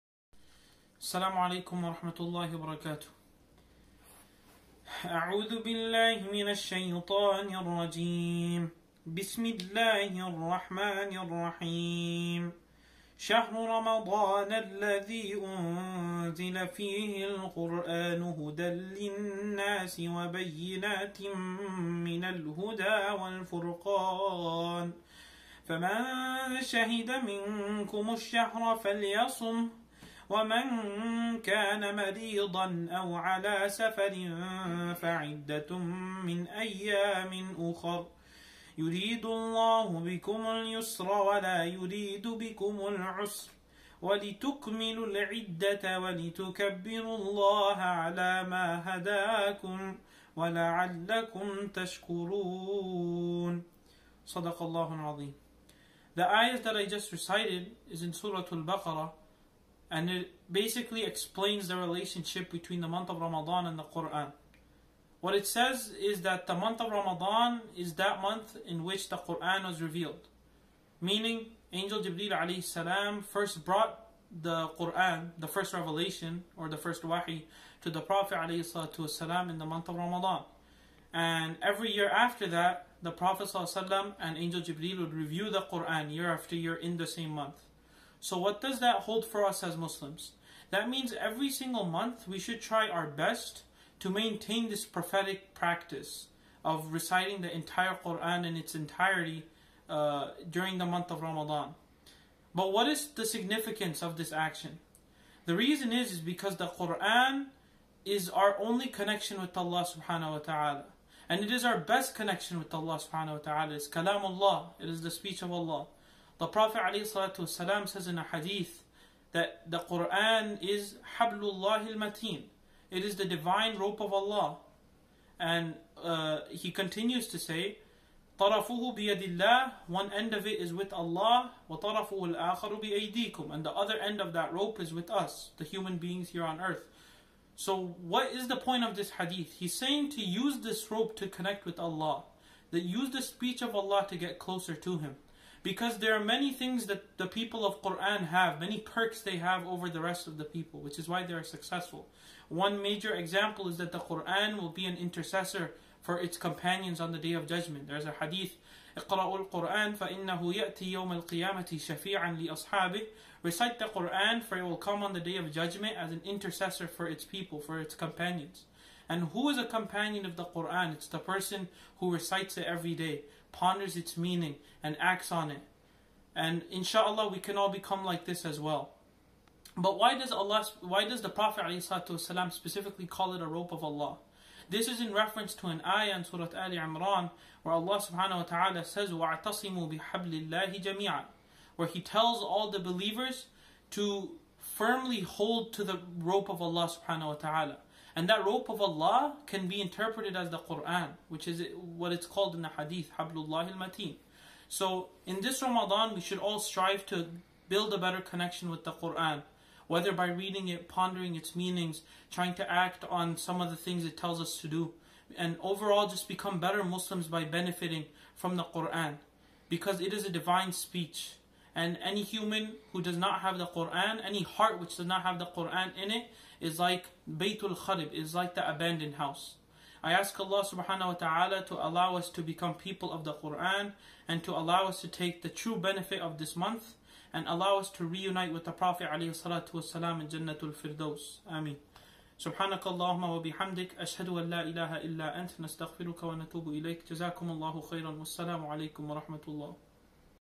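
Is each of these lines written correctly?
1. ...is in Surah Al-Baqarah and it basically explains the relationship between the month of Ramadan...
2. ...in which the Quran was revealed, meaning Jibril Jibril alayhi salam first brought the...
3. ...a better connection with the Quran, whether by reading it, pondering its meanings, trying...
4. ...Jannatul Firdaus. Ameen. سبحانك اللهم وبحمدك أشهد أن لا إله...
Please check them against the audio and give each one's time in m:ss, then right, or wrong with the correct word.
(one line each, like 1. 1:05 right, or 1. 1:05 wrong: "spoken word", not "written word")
1. 0:57 right
2. 1:08 wrong: "Angel", not "Jibril"
3. 3:27 right
4. 4:00 right.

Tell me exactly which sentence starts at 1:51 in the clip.
And it is our best connection with Allah subhanahu wa ta'ala.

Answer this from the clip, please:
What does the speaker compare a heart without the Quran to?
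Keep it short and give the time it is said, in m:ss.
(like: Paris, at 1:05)
the abandoned house, at 3:48.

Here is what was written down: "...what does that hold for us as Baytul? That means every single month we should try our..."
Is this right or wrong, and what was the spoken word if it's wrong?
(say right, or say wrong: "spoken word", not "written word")
wrong: "Muslims", not "Baytul".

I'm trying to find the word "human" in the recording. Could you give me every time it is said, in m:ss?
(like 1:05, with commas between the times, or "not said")
2:15, 3:42.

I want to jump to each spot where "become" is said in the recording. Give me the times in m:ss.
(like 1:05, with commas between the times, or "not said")
2:57, 3:36, 3:52.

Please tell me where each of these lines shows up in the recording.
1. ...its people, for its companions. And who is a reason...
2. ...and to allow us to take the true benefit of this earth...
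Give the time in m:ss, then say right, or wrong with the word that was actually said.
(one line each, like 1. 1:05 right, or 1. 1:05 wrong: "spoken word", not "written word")
1. 2:47 wrong: "companion", not "reason"
2. 3:54 wrong: "month", not "earth".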